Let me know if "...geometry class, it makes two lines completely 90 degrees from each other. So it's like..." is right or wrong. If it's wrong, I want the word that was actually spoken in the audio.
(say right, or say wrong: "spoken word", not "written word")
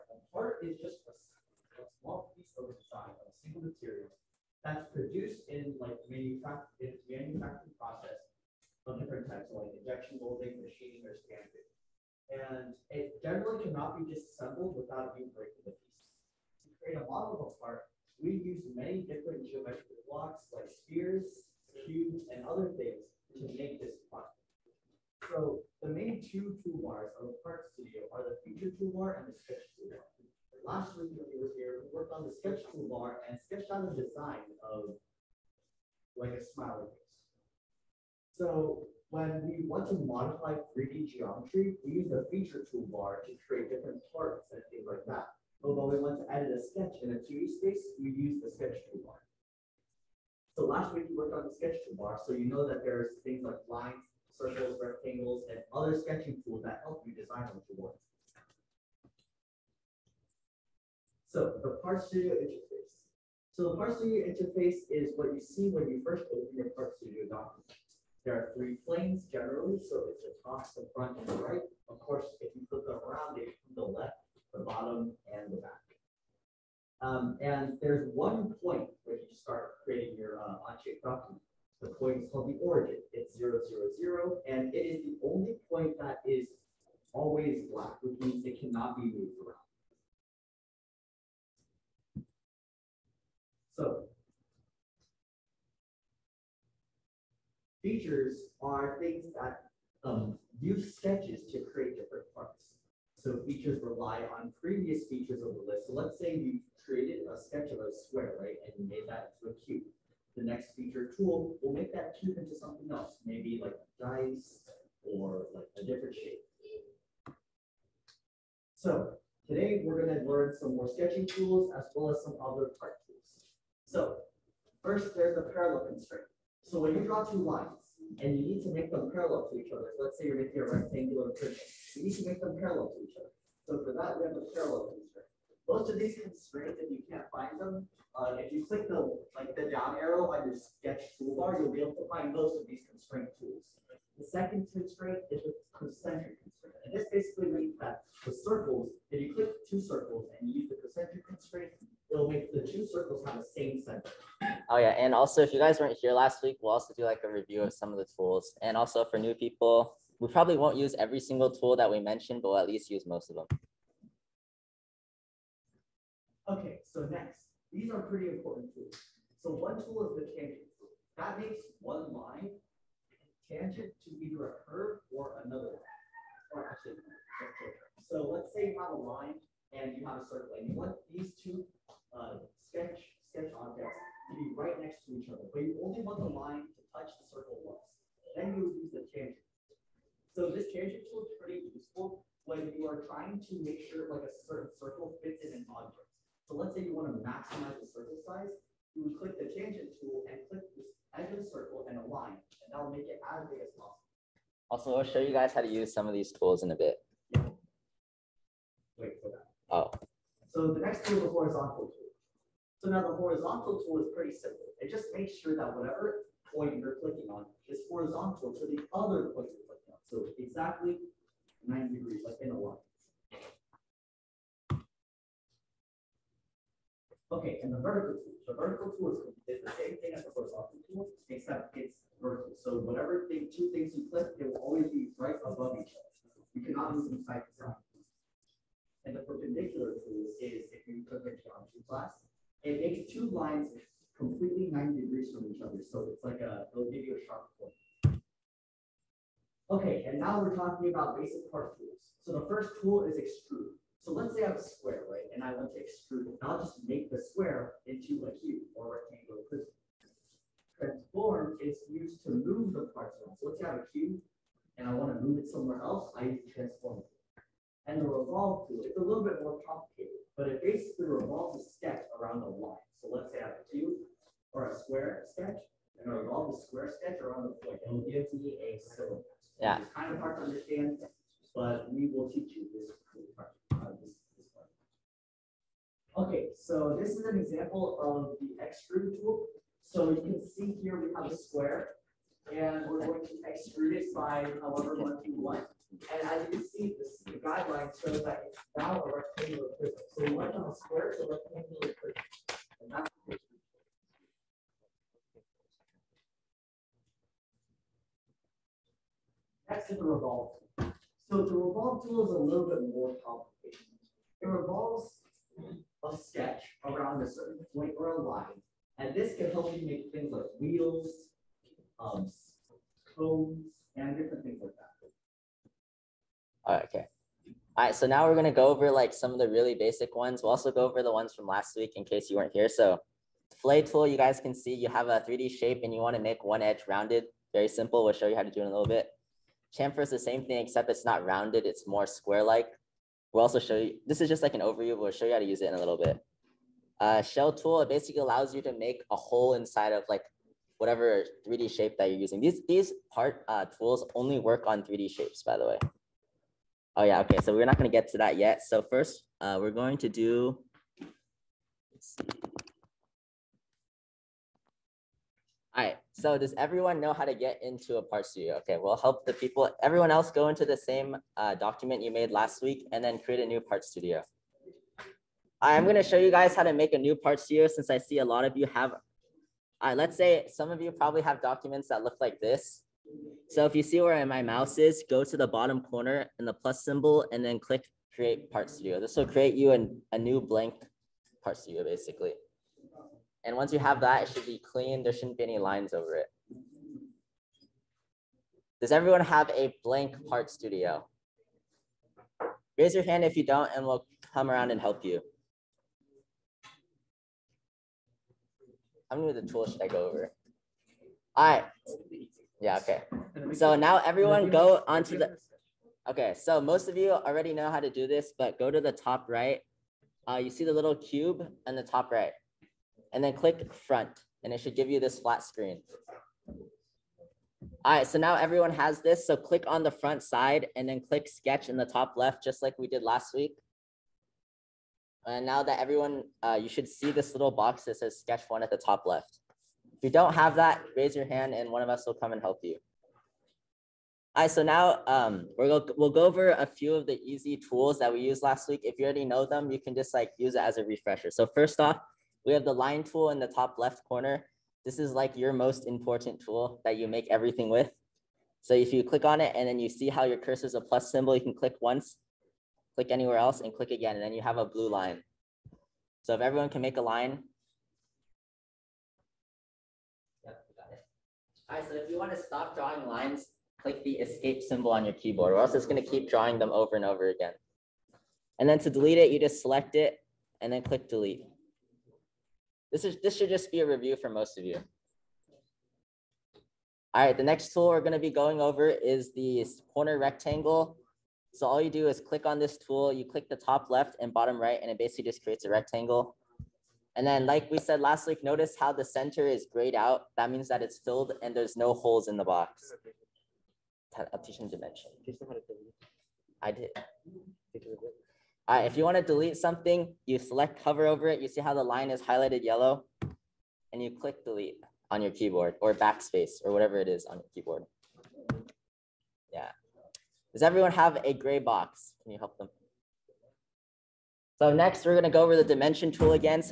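right.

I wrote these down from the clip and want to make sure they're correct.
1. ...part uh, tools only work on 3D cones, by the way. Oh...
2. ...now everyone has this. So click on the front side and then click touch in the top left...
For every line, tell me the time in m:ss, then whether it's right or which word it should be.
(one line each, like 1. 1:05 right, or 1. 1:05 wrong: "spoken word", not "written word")
1. 5:53 wrong: "shapes", not "cones"
2. 7:08 wrong: "sketch", not "touch".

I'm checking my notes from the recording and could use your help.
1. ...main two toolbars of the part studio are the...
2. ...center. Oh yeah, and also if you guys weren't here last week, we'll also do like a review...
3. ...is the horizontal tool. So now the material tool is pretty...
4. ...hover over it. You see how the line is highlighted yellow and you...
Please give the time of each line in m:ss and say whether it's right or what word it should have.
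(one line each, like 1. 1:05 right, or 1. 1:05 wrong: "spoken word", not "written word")
1. 0:25 right
2. 2:33 right
3. 3:31 wrong: "horizontal", not "material"
4. 8:30 right.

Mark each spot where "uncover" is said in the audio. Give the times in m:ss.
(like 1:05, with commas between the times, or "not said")
not said.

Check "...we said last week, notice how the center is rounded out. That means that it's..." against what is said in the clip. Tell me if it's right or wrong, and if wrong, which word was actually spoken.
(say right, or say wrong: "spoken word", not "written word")
wrong: "grayed", not "rounded".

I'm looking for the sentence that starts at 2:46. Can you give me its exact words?
Okay, so next, these are pretty important tools.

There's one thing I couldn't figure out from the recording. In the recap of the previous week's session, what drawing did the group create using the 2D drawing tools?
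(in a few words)
A smiley face.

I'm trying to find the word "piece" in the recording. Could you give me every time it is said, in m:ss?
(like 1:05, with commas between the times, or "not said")
0:02, 0:15.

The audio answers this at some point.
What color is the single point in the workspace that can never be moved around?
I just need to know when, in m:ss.
1:27.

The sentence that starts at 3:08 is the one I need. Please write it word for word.
Then you would use the tangent.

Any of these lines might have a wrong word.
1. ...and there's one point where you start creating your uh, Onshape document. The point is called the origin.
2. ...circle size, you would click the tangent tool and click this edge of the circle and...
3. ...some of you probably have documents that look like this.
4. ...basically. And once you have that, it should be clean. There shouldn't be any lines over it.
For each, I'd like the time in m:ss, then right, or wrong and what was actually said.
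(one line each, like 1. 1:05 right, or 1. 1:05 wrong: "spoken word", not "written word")
1. 1:17 right
2. 3:17 right
3. 6:20 right
4. 6:31 right.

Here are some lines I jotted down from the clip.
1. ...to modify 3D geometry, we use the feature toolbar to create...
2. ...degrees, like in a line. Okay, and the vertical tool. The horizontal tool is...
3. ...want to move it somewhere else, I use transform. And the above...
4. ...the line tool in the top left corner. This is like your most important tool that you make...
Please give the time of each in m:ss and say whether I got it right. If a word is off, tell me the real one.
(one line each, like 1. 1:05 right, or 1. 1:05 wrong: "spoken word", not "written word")
1. 0:39 right
2. 3:41 wrong: "vertical", not "horizontal"
3. 4:24 wrong: "revolve", not "above"
4. 7:32 right.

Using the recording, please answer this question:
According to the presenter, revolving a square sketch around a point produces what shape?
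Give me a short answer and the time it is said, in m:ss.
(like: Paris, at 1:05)
A cylinder, at 4:38.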